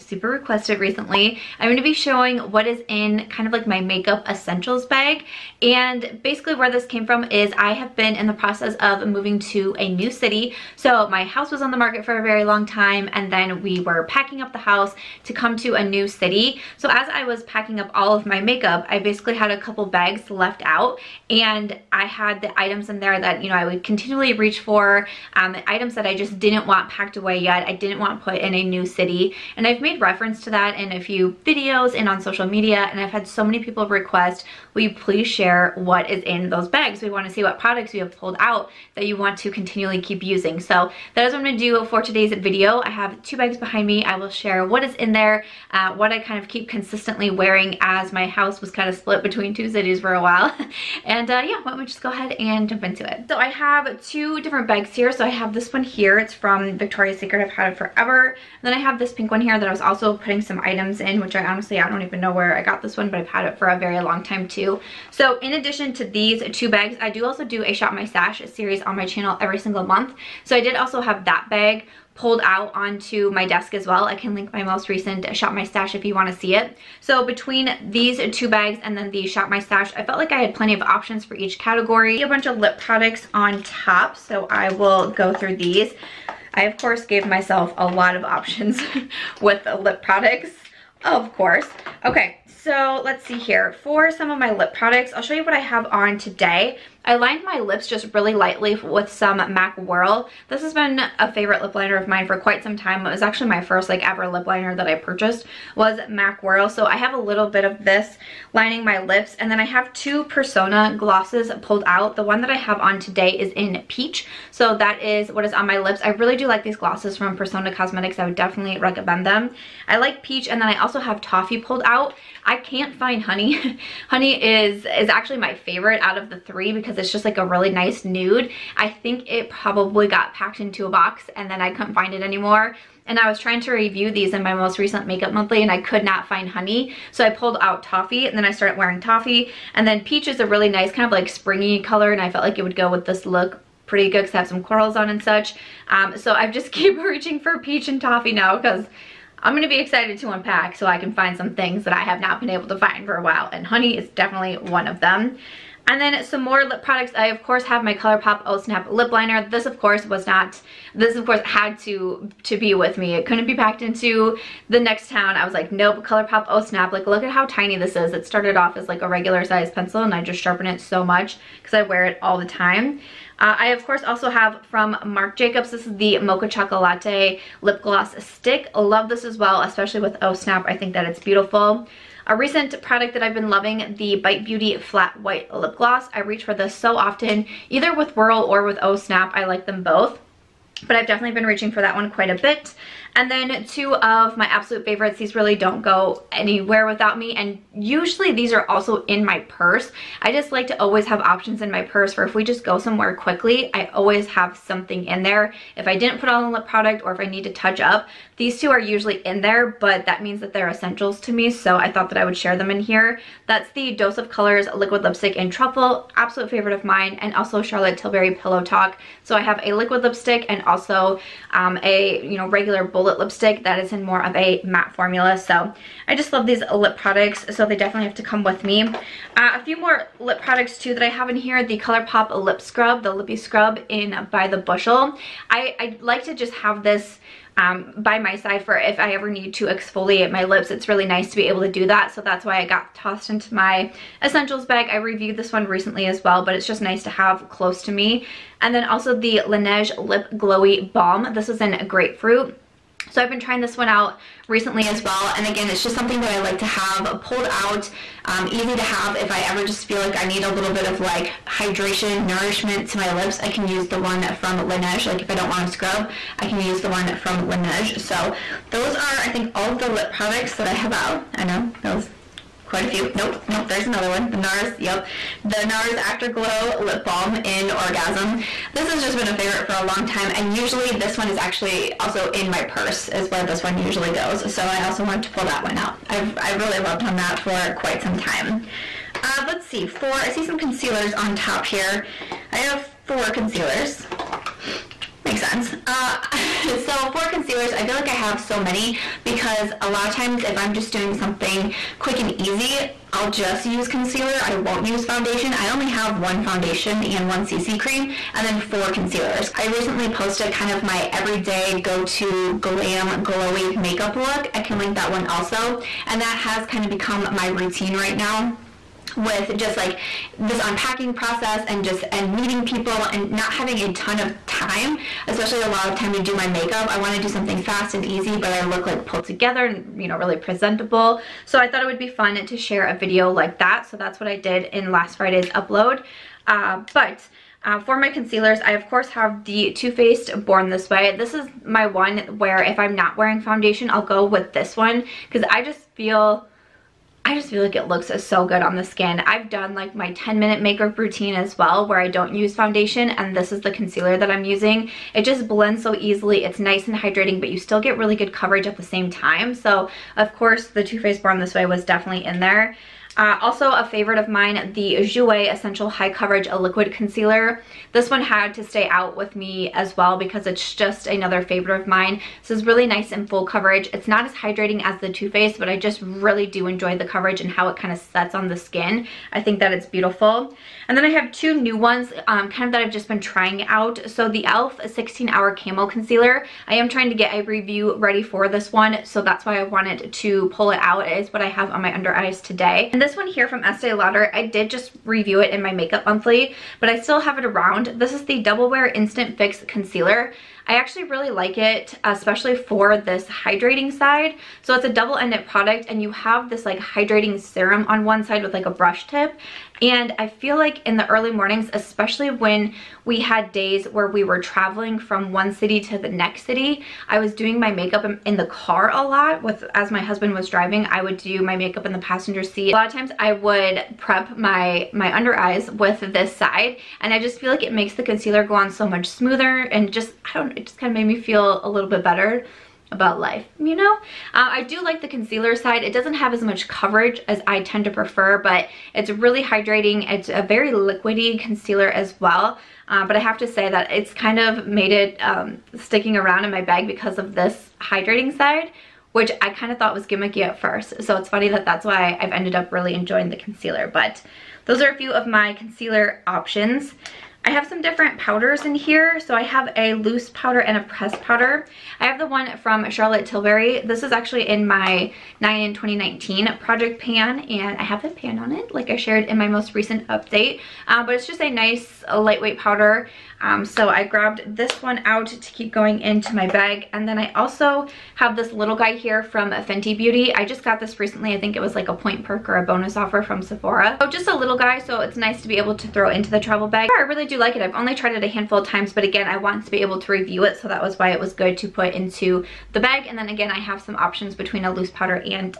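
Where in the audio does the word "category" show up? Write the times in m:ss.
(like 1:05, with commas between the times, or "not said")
1:21.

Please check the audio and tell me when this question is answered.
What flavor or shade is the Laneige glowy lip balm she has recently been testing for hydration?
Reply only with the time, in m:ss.
4:11.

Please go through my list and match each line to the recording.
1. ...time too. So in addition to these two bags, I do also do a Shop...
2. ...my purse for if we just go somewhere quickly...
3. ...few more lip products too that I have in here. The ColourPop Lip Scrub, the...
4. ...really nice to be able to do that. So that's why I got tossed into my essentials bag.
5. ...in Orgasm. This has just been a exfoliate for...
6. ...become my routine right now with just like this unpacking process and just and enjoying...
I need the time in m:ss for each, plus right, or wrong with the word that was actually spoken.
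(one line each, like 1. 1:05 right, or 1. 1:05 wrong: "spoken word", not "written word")
1. 1:04 right
2. 3:21 right
3. 3:49 right
4. 4:00 right
5. 4:37 wrong: "favorite", not "exfoliate"
6. 5:16 wrong: "meeting", not "enjoying".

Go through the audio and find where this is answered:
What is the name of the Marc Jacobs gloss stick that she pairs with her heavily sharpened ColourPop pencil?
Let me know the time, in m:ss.
2:56.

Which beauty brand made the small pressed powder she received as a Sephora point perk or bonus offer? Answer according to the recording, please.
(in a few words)
Fenty Beauty.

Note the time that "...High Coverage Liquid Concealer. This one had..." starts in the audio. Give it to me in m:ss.
6:05.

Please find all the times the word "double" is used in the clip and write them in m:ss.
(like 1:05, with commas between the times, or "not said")
6:38, 6:44.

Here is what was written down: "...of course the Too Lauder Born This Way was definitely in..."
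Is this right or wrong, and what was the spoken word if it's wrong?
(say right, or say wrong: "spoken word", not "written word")
wrong: "Faced", not "Lauder".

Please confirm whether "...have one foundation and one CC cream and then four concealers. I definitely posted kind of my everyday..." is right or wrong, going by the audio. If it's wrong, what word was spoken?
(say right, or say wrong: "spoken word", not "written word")
wrong: "recently", not "definitely".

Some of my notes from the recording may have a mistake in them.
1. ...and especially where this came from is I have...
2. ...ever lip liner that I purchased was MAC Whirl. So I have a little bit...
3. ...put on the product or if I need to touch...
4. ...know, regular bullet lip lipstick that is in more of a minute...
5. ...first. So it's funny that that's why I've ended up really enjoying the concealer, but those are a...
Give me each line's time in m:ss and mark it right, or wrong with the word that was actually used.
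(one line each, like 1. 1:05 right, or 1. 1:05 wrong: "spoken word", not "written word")
1. 0:05 wrong: "basically", not "especially"
2. 1:44 right
3. 3:26 right
4. 3:42 wrong: "matte", not "minute"
5. 7:30 right.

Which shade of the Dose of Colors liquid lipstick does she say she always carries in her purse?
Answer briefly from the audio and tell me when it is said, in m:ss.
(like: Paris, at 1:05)
Truffle, at 3:35.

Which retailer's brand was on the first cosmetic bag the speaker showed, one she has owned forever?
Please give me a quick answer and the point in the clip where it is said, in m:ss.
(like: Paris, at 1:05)
Victoria's Secret, at 0:56.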